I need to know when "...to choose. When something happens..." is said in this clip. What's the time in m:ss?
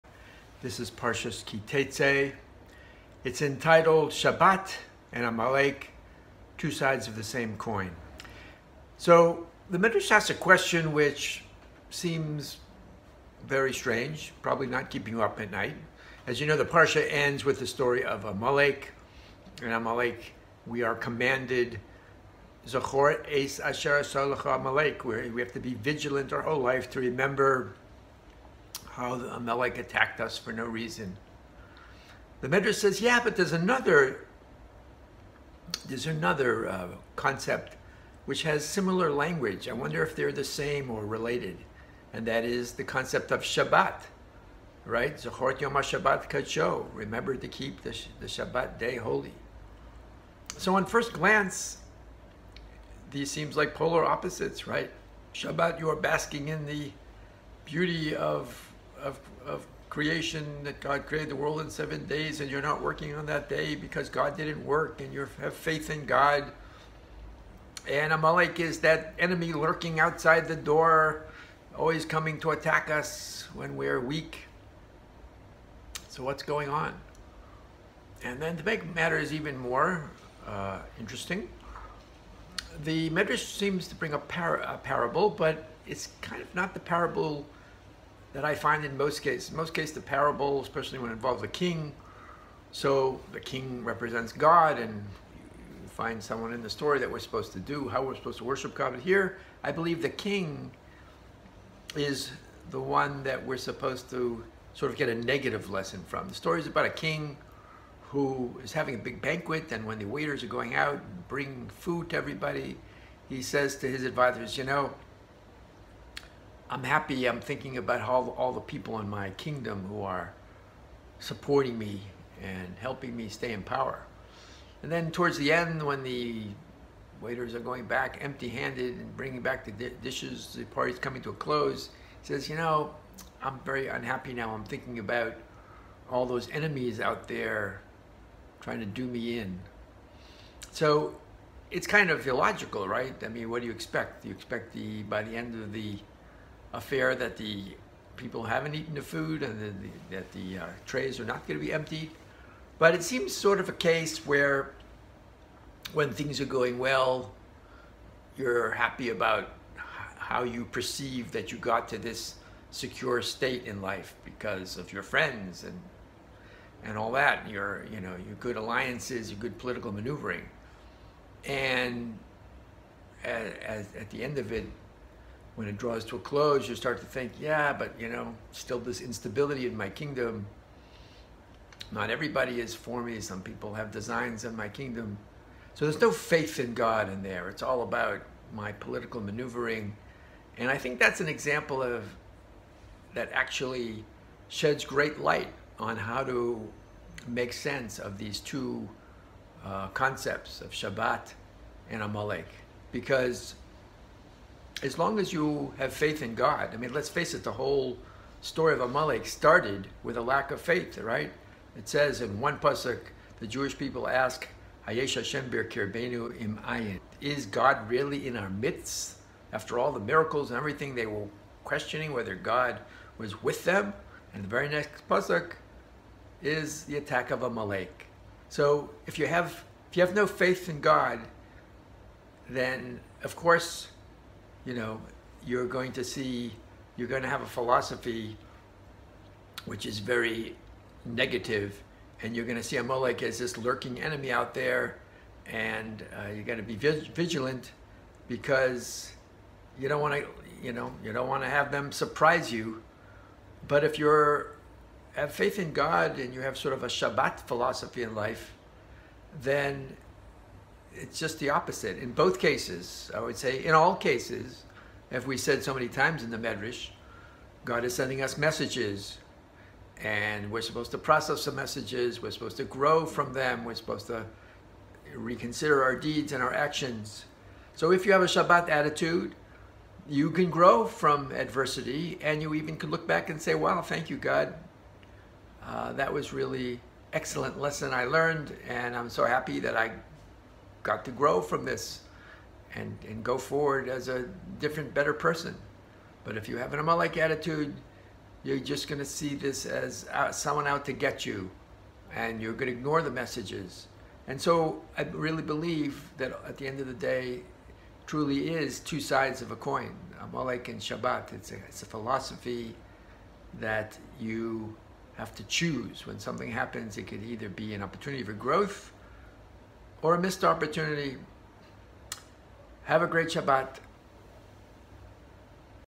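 5:15.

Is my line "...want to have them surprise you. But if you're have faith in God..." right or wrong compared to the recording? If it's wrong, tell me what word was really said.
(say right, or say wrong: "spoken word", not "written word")
right.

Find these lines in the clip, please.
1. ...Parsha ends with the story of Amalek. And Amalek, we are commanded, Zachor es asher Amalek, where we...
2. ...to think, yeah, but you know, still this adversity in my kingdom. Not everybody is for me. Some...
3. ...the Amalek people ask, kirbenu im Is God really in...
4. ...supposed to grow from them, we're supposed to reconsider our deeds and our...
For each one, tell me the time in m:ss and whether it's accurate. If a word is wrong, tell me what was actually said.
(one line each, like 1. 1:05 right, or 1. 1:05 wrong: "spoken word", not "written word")
1. 0:16 right
2. 2:56 wrong: "instability", not "adversity"
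3. 3:33 wrong: "Jewish", not "Amalek"
4. 4:32 right.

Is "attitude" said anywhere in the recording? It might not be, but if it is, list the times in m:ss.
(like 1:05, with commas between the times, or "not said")
4:38, 4:57.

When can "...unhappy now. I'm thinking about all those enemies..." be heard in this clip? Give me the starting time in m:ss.
2:13.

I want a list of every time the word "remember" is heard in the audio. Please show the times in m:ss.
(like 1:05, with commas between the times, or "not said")
0:26, 0:46.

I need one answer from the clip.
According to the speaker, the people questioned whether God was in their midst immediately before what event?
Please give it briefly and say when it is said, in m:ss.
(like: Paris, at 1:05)
the attack of Amalek, at 3:46.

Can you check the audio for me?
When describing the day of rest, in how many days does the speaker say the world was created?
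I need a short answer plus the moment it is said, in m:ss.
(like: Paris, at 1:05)
7, at 1:01.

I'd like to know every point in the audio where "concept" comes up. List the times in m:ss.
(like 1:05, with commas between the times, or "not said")
0:37, 0:42, 3:19.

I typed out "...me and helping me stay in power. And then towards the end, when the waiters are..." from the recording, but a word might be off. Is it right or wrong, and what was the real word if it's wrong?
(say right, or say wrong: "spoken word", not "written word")
right.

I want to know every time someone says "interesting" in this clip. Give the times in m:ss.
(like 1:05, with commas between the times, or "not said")
1:20.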